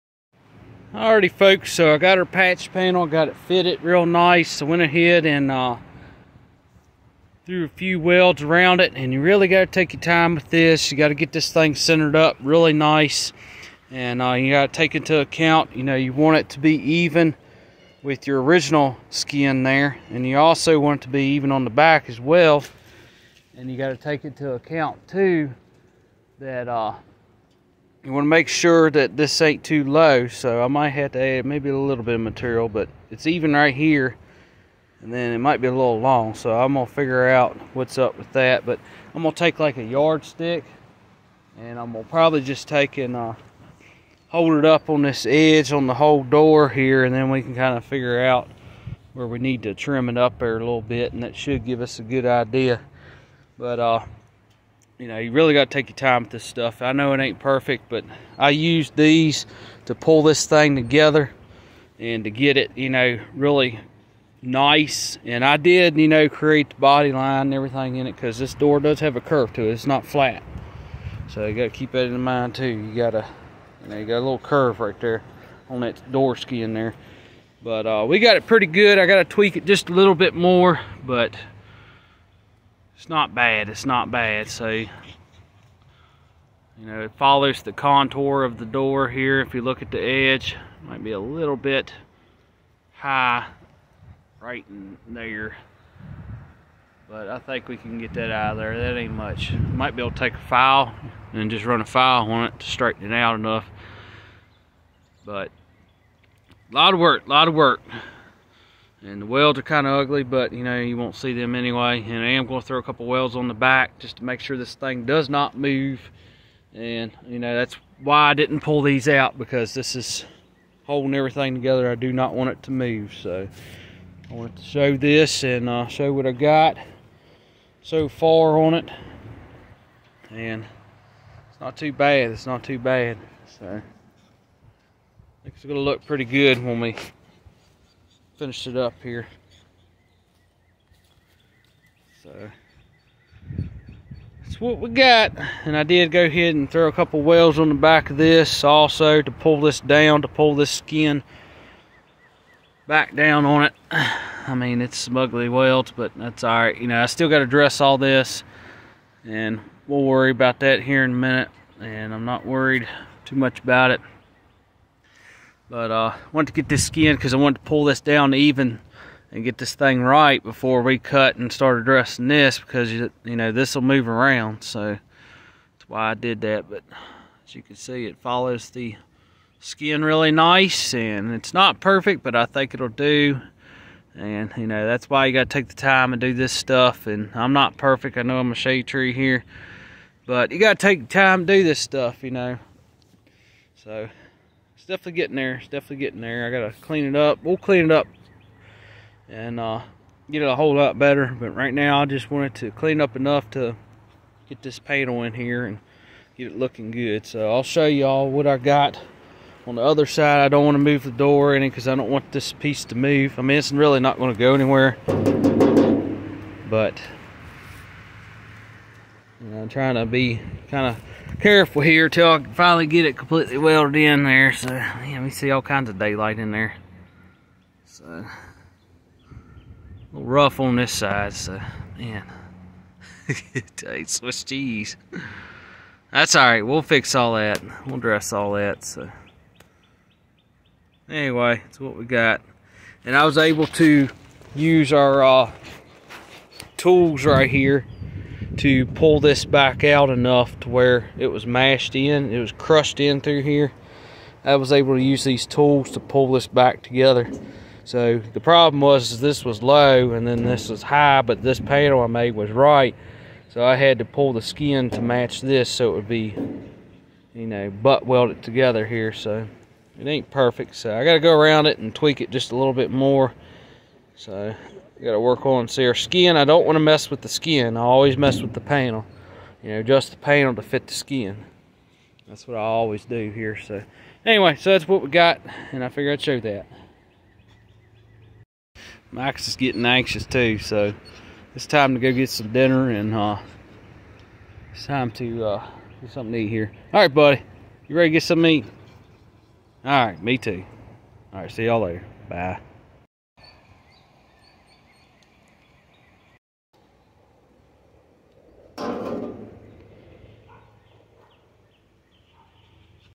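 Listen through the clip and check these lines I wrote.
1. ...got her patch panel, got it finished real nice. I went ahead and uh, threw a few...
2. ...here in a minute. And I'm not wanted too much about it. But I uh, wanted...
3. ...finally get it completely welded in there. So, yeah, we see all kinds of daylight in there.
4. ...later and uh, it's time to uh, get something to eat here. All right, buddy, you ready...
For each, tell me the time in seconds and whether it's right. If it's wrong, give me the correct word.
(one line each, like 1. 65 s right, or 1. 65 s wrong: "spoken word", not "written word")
1. 1 s wrong: "fitted", not "finished"
2. 160 s wrong: "worried", not "wanted"
3. 222 s right
4. 292 s wrong: "dinner", not "later".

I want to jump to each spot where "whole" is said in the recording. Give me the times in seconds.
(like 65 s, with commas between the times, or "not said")
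45 s, 200 s.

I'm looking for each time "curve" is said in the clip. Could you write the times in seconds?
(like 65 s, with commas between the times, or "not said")
69 s, 74 s.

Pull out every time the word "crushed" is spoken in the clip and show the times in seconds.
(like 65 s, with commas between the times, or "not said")
252 s.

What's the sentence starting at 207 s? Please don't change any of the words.
So I'll show y'all what I got on the other side.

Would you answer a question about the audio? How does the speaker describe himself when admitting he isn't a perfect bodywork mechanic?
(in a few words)
shade tree.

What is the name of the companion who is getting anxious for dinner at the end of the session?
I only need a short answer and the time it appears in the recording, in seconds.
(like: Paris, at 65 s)
Max, at 289 s.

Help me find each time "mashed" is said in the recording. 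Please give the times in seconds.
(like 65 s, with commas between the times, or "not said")
251 s.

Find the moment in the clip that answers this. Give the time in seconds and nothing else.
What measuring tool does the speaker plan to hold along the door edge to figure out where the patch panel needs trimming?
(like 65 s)
39 s.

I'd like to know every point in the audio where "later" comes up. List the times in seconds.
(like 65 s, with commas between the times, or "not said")
301 s.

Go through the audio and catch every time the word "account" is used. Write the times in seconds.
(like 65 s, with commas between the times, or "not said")
15 s, 24 s.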